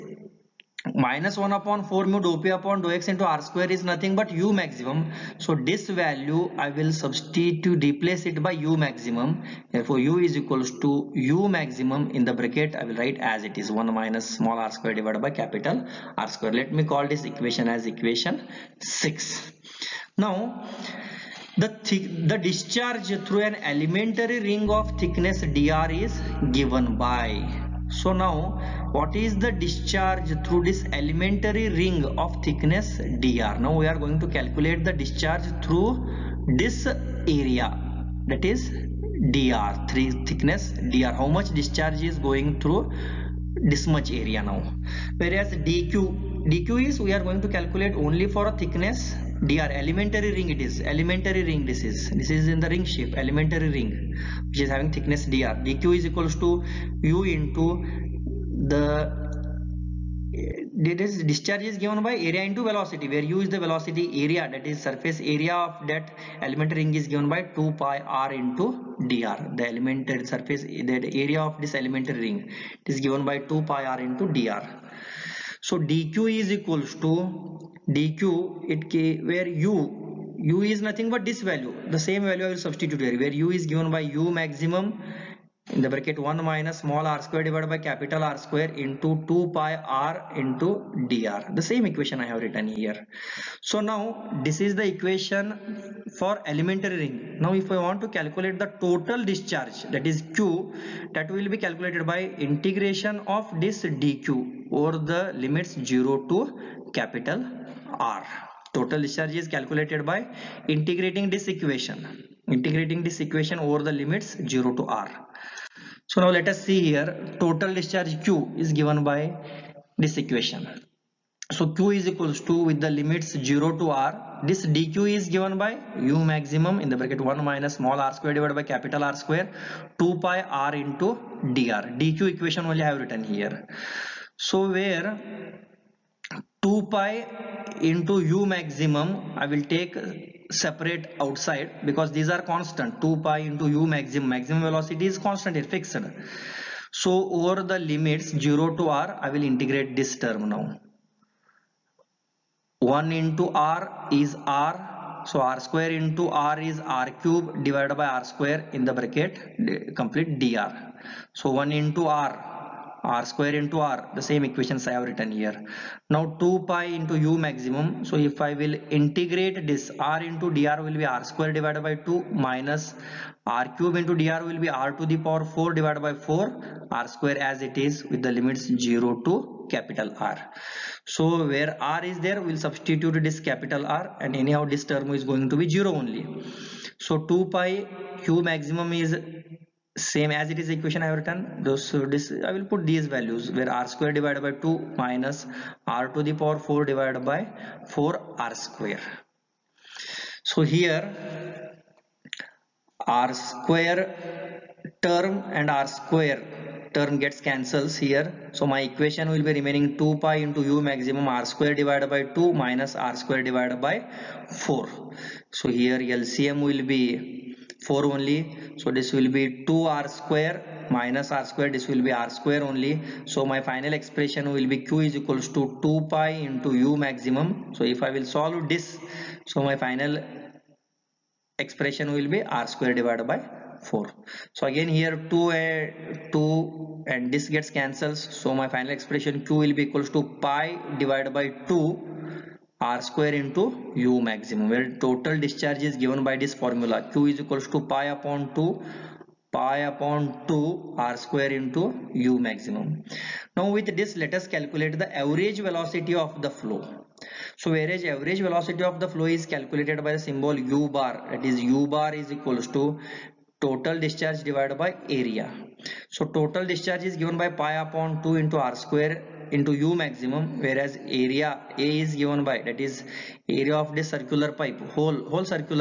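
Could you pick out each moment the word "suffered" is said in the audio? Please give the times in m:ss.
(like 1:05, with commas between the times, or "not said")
not said.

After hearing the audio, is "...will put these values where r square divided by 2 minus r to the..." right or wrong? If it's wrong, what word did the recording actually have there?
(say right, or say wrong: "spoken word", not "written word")
right.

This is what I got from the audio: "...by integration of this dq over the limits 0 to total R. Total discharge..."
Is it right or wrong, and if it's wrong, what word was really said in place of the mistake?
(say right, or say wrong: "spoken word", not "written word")
wrong: "capital", not "total".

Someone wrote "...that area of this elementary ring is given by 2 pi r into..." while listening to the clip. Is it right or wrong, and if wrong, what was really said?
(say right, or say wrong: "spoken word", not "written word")
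right.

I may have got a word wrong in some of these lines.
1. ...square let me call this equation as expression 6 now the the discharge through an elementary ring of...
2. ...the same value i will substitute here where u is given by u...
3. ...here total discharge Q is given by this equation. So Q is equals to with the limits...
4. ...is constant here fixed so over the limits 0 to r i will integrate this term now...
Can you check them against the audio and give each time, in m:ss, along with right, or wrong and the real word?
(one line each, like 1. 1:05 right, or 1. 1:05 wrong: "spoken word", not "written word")
1. 0:16 wrong: "equation", not "expression"
2. 1:21 right
3. 1:56 right
4. 2:25 right.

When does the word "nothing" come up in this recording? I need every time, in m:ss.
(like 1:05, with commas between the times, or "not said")
0:03, 1:20.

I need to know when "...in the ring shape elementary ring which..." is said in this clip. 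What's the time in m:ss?
0:52.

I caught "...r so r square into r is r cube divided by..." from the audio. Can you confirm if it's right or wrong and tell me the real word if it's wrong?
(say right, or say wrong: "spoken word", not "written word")
right.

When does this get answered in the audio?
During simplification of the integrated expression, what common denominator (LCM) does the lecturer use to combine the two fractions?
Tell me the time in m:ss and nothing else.
3:35.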